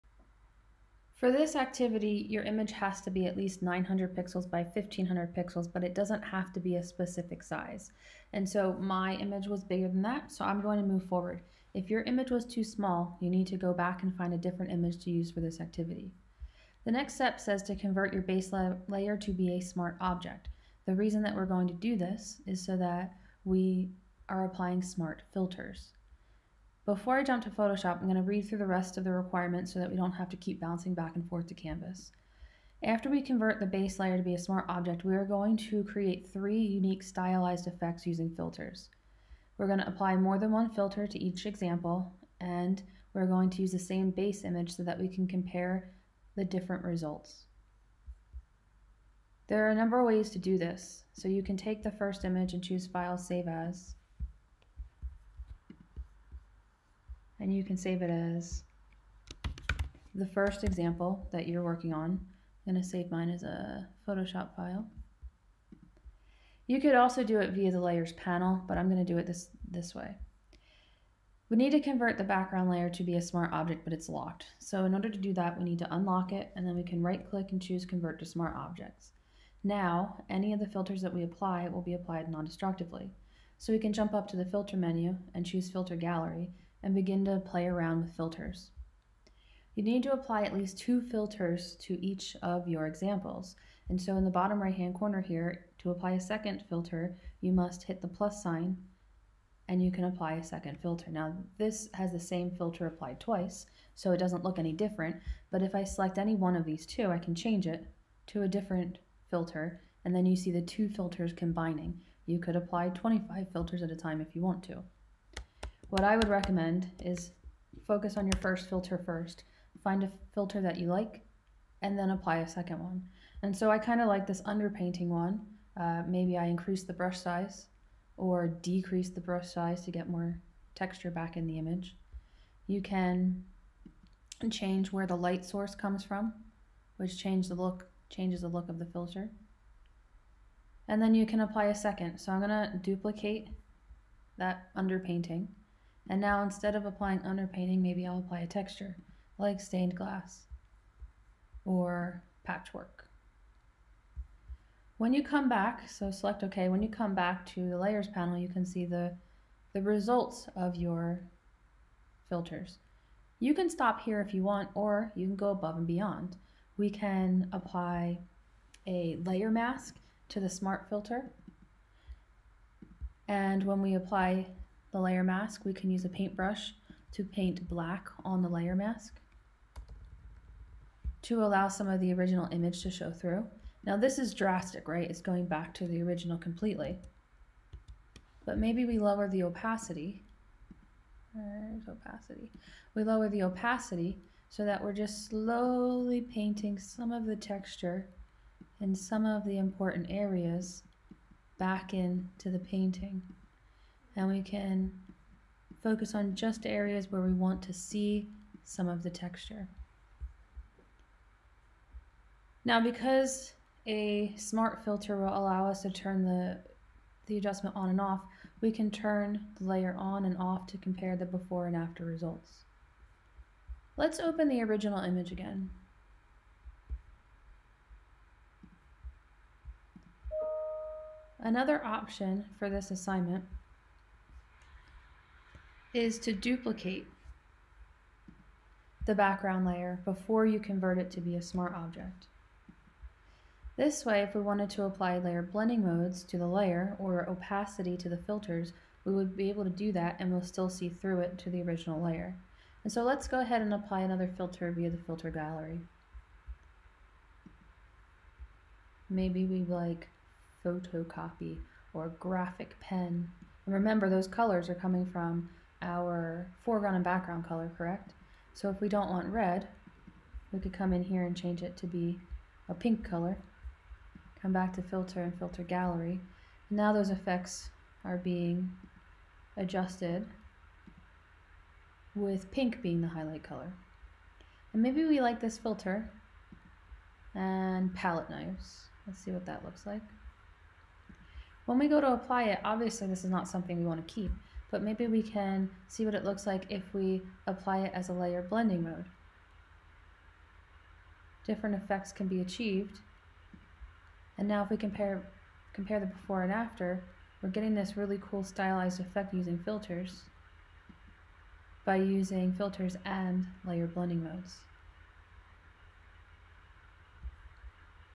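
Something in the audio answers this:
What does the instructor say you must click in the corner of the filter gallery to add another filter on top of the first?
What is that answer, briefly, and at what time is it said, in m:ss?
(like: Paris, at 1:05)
plus sign, at 1:38.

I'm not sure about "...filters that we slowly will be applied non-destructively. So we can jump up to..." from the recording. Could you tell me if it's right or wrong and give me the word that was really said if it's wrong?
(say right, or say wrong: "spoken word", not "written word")
wrong: "apply", not "slowly".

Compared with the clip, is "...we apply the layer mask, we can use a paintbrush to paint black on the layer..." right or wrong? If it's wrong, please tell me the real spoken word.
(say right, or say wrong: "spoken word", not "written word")
right.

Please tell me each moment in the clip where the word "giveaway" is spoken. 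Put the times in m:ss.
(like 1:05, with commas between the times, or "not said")
not said.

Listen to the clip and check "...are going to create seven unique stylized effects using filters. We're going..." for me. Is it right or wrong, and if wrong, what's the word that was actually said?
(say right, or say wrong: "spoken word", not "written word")
wrong: "three", not "seven".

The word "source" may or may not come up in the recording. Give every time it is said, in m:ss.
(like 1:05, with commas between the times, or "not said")
2:15.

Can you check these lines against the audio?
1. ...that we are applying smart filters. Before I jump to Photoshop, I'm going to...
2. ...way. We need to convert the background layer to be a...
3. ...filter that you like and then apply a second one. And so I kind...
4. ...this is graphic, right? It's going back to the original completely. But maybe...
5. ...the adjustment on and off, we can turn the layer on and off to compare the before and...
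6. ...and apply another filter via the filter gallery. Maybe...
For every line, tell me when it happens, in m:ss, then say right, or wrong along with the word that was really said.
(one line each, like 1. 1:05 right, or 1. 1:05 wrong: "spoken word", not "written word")
1. 0:22 right
2. 1:09 right
3. 2:00 right
4. 3:03 wrong: "drastic", not "graphic"
5. 3:37 right
6. 4:13 right.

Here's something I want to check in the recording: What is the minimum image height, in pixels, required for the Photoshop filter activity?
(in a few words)
1500 pixels.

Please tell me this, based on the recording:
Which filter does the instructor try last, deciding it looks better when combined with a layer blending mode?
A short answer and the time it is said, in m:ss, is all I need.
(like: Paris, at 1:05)
palette knives, at 4:47.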